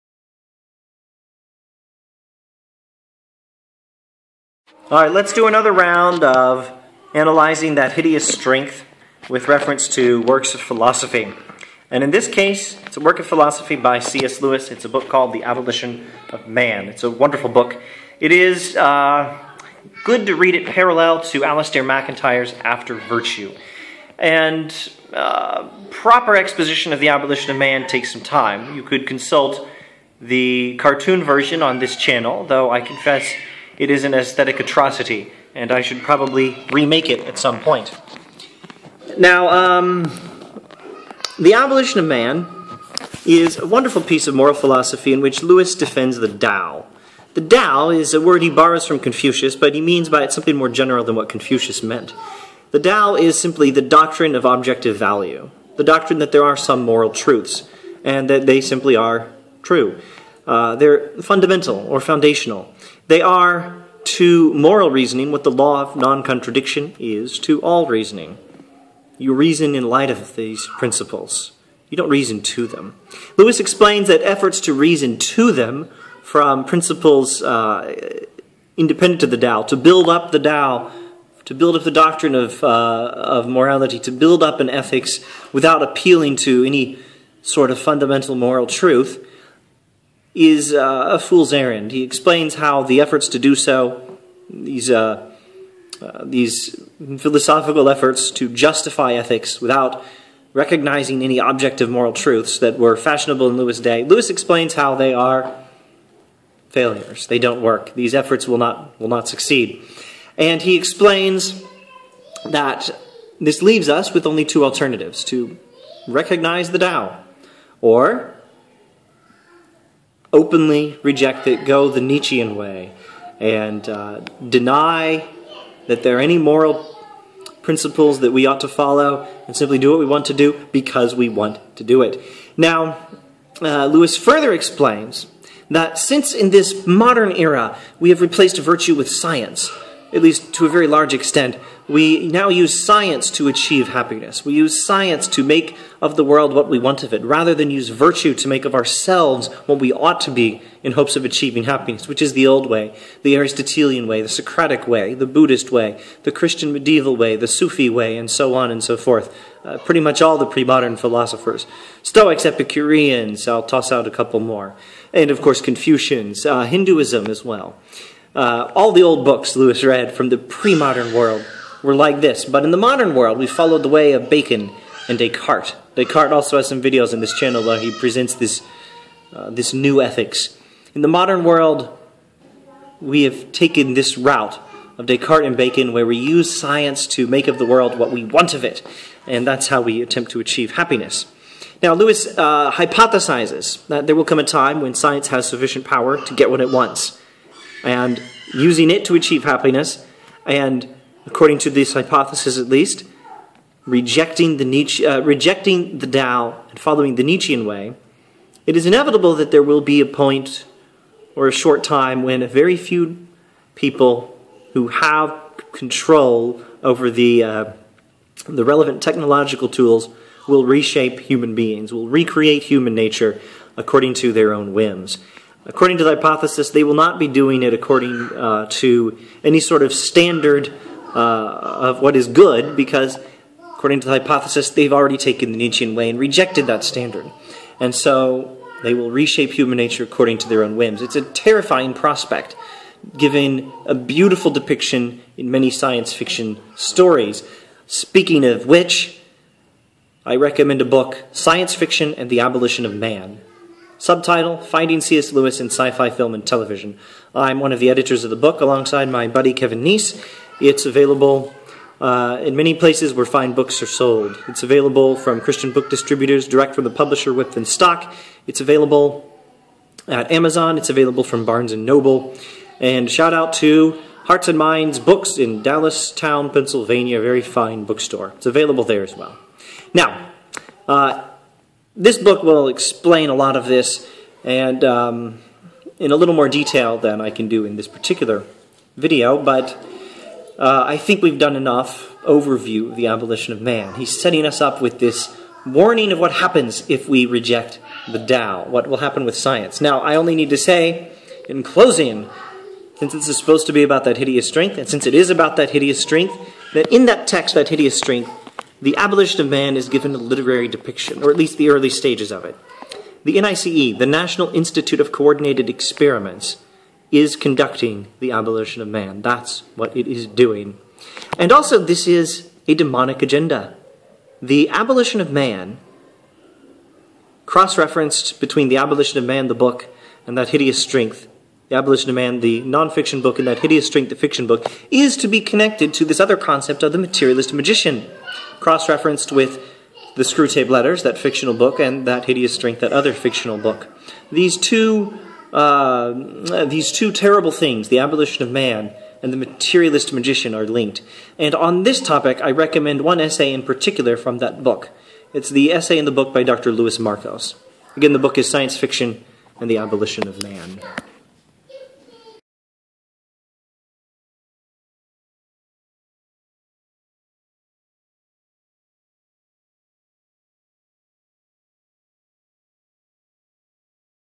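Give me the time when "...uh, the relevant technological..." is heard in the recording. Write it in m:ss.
3:37.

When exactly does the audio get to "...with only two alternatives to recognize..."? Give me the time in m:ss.
1:54.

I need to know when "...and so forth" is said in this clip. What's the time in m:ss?
2:38.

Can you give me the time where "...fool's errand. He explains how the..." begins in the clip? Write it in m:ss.
1:31.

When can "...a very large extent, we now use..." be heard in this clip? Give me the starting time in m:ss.
2:20.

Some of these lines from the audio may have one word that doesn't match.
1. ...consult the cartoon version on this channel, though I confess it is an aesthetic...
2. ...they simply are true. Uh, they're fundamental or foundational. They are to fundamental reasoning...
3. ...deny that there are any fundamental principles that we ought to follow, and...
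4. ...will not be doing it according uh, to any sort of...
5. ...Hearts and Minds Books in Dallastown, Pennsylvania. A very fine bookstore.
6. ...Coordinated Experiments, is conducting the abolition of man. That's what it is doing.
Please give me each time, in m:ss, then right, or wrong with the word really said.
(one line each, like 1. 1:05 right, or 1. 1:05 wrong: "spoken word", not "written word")
1. 0:29 right
2. 0:58 wrong: "moral", not "fundamental"
3. 2:04 wrong: "moral", not "fundamental"
4. 3:46 right
5. 4:34 right
6. 5:15 right.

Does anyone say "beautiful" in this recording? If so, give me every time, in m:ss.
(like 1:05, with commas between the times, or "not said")
4:03.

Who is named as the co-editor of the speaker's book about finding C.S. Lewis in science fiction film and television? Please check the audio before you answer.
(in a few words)
Kevin Neece.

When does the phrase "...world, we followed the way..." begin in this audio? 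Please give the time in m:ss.
2:53.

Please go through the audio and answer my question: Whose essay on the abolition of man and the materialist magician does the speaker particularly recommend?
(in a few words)
Louis Markos.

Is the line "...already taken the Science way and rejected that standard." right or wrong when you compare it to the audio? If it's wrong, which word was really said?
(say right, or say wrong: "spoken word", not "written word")
wrong: "Nietzschean", not "Science".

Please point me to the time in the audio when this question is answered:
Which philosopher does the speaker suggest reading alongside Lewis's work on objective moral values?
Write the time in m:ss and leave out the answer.
0:21.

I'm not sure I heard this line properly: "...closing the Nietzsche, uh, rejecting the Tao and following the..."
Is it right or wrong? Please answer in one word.
wrong.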